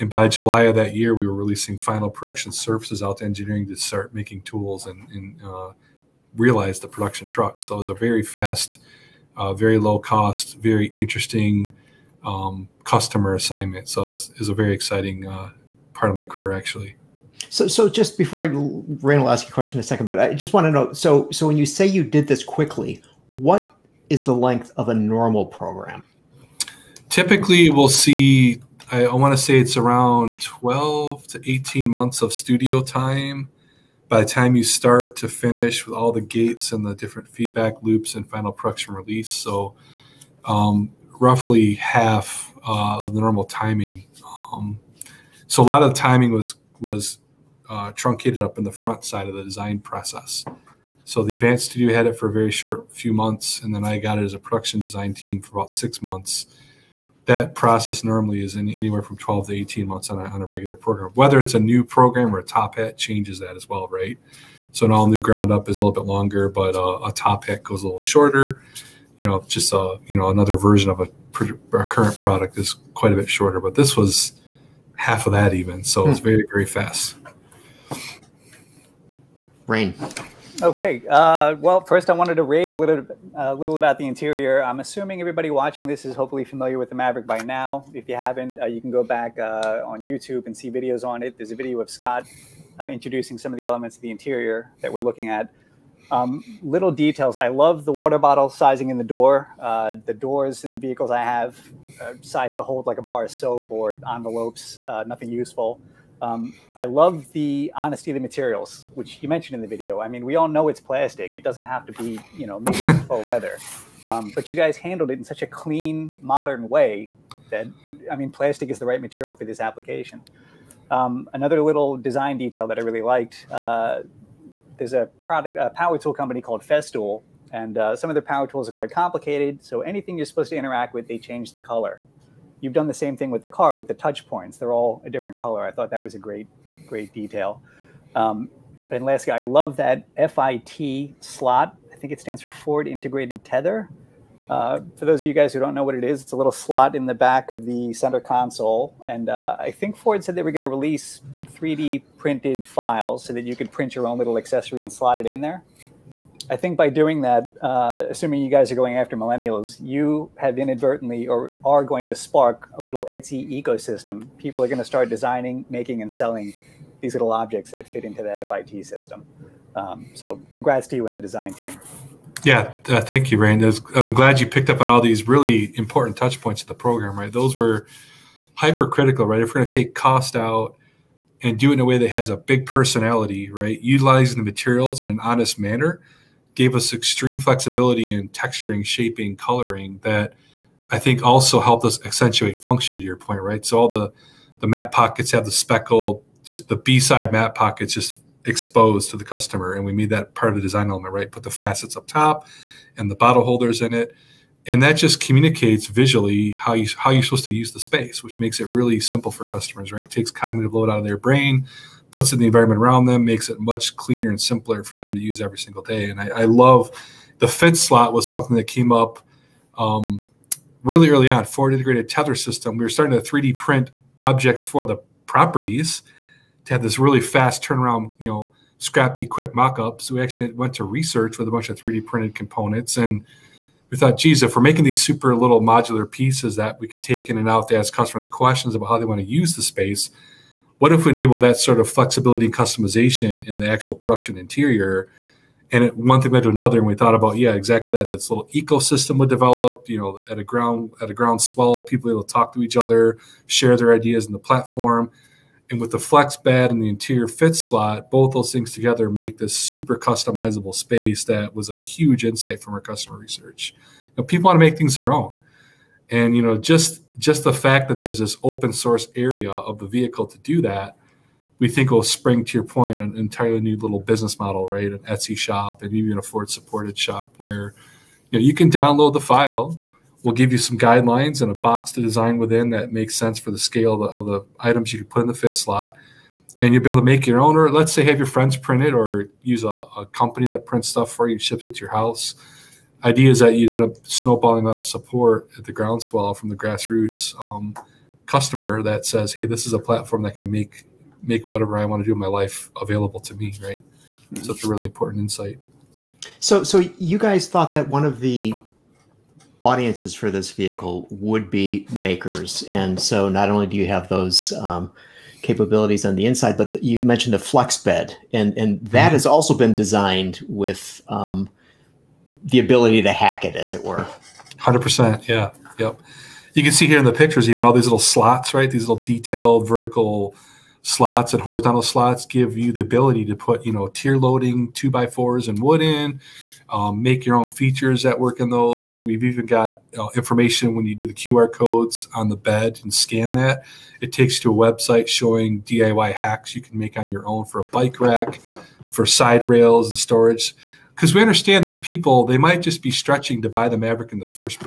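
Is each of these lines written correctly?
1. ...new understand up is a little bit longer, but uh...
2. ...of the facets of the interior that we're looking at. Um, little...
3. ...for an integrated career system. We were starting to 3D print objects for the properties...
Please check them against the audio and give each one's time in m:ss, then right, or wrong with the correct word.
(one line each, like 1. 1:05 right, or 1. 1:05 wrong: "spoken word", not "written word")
1. 1:05 wrong: "ground", not "understand"
2. 1:33 wrong: "elements", not "facets"
3. 3:41 wrong: "tether", not "career".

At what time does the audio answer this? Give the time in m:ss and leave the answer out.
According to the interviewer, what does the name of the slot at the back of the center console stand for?
2:22.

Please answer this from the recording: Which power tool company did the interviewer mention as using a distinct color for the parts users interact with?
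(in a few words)
Festool.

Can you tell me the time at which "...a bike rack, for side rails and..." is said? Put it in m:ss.
5:47.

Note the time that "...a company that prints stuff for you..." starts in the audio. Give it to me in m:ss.
4:49.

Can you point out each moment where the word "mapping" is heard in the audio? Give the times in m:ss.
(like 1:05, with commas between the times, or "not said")
not said.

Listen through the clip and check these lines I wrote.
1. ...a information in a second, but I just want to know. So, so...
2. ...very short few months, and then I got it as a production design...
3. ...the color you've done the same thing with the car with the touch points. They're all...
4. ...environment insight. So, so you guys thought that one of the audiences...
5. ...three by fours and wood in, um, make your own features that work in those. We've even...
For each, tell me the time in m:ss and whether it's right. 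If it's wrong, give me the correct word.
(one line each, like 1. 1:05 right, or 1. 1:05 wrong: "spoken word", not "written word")
1. 0:19 wrong: "question", not "information"
2. 0:52 right
3. 2:11 right
4. 5:04 wrong: "important", not "environment"
5. 5:34 wrong: "two", not "three".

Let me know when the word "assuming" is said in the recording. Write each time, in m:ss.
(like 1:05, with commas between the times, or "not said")
1:24, 2:38.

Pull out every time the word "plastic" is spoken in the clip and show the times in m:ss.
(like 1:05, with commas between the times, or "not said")
1:50, 1:58.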